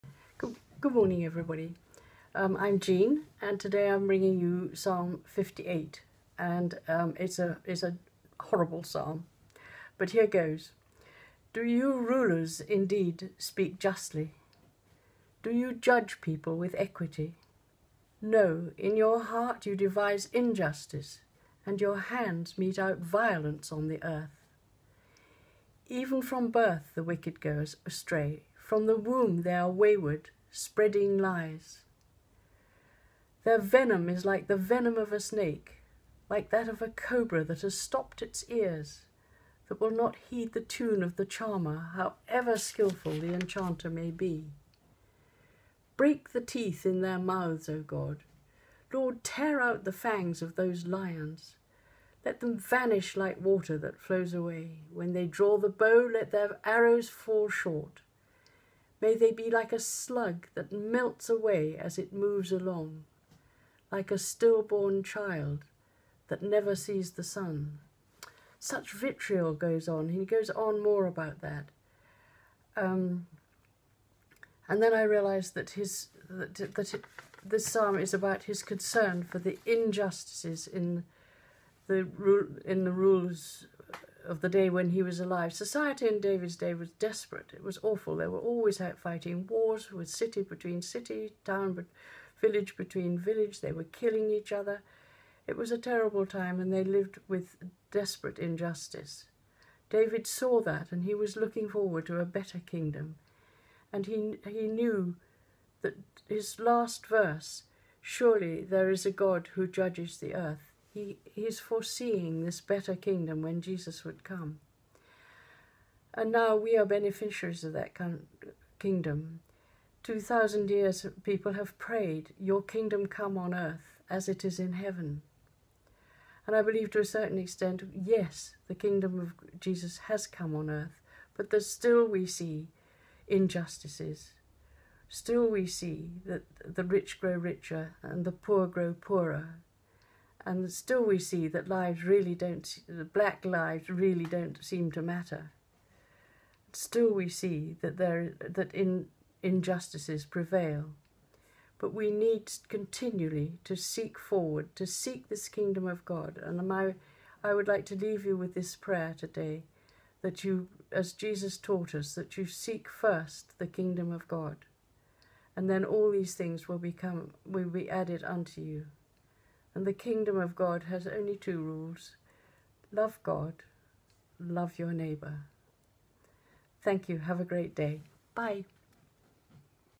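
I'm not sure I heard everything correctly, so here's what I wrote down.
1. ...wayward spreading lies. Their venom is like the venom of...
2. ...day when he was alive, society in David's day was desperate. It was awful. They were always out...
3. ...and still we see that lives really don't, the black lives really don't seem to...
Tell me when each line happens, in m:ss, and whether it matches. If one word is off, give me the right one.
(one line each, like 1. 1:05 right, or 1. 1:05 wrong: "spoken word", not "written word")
1. 0:29 right
2. 1:24 right
3. 2:20 right.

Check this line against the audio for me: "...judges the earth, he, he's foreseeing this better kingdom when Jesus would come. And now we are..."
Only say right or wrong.
right.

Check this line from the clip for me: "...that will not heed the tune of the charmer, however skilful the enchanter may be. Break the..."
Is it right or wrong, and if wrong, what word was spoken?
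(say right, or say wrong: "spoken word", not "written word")
right.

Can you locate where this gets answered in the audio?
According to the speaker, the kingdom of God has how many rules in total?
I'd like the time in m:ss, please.
2:51.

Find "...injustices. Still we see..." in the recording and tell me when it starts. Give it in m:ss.
2:13.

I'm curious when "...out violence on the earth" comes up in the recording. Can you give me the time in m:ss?
0:22.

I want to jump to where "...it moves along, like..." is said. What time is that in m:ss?
1:01.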